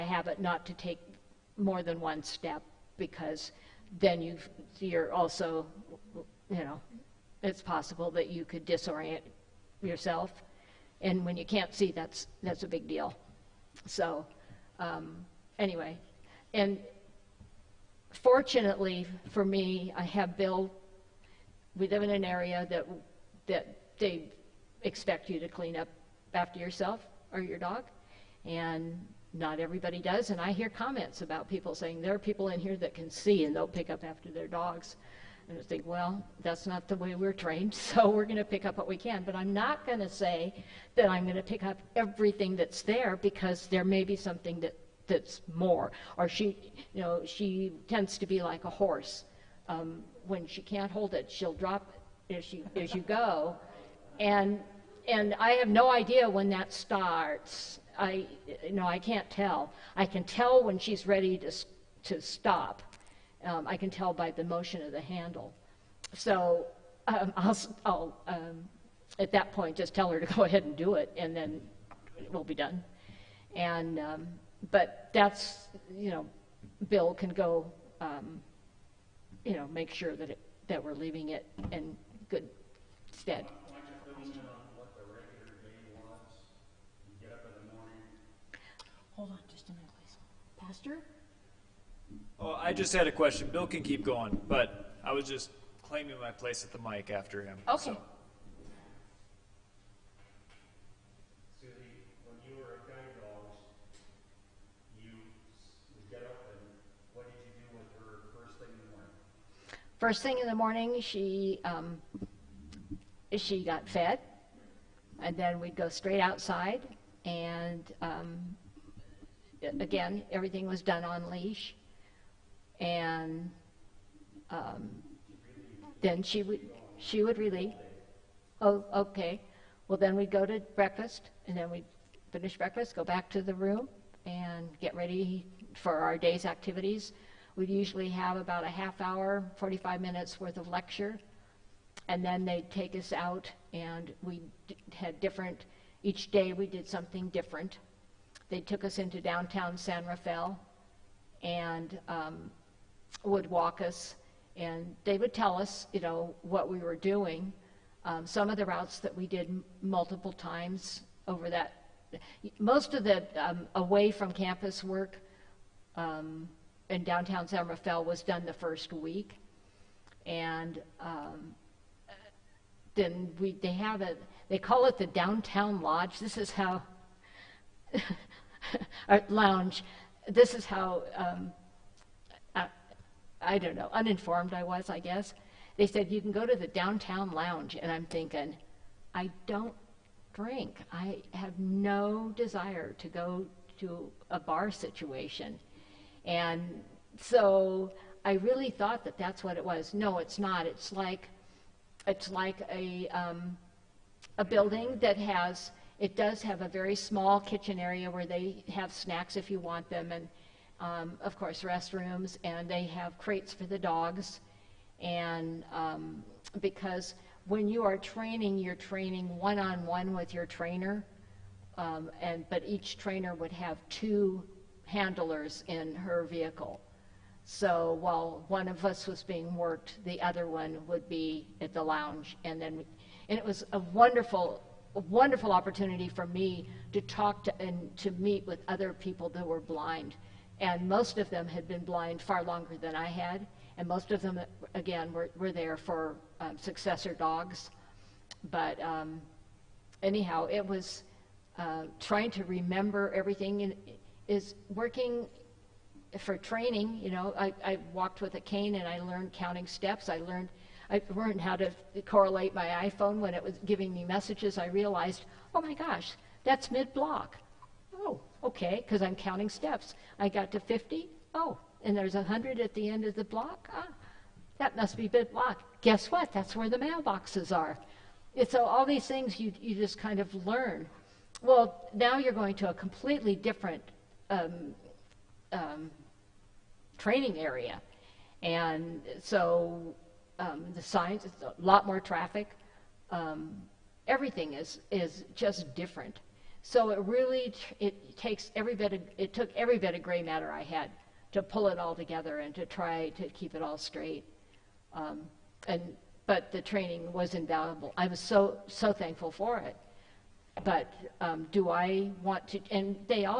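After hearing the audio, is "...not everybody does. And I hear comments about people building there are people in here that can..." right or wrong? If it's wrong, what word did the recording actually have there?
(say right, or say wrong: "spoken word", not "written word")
wrong: "saying", not "building".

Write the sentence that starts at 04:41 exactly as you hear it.
Well, now you're going to a completely different um, um, training area.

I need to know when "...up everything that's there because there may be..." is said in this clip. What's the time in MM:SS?
00:41.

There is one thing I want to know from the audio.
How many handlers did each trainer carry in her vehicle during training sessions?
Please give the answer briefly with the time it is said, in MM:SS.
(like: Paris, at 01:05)
2, at 03:43.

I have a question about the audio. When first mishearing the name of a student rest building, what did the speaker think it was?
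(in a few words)
downtown lodge.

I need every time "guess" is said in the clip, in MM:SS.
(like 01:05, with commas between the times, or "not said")
03:04, 04:35.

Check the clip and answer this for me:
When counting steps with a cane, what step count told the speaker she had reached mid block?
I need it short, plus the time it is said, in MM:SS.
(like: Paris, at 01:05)
50, at 04:30.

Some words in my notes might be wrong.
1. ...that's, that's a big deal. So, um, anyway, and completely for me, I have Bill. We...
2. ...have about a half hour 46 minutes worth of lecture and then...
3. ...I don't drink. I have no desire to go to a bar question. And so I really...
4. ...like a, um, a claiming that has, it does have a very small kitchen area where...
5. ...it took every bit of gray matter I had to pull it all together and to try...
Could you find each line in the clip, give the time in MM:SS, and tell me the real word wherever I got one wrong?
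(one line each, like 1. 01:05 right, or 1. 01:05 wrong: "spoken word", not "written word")
1. 00:11 wrong: "fortunately", not "completely"
2. 02:18 wrong: "45", not "46"
3. 03:09 wrong: "situation", not "question"
4. 03:22 wrong: "building", not "claiming"
5. 04:59 right.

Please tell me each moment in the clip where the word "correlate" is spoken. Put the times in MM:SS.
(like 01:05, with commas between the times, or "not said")
04:22.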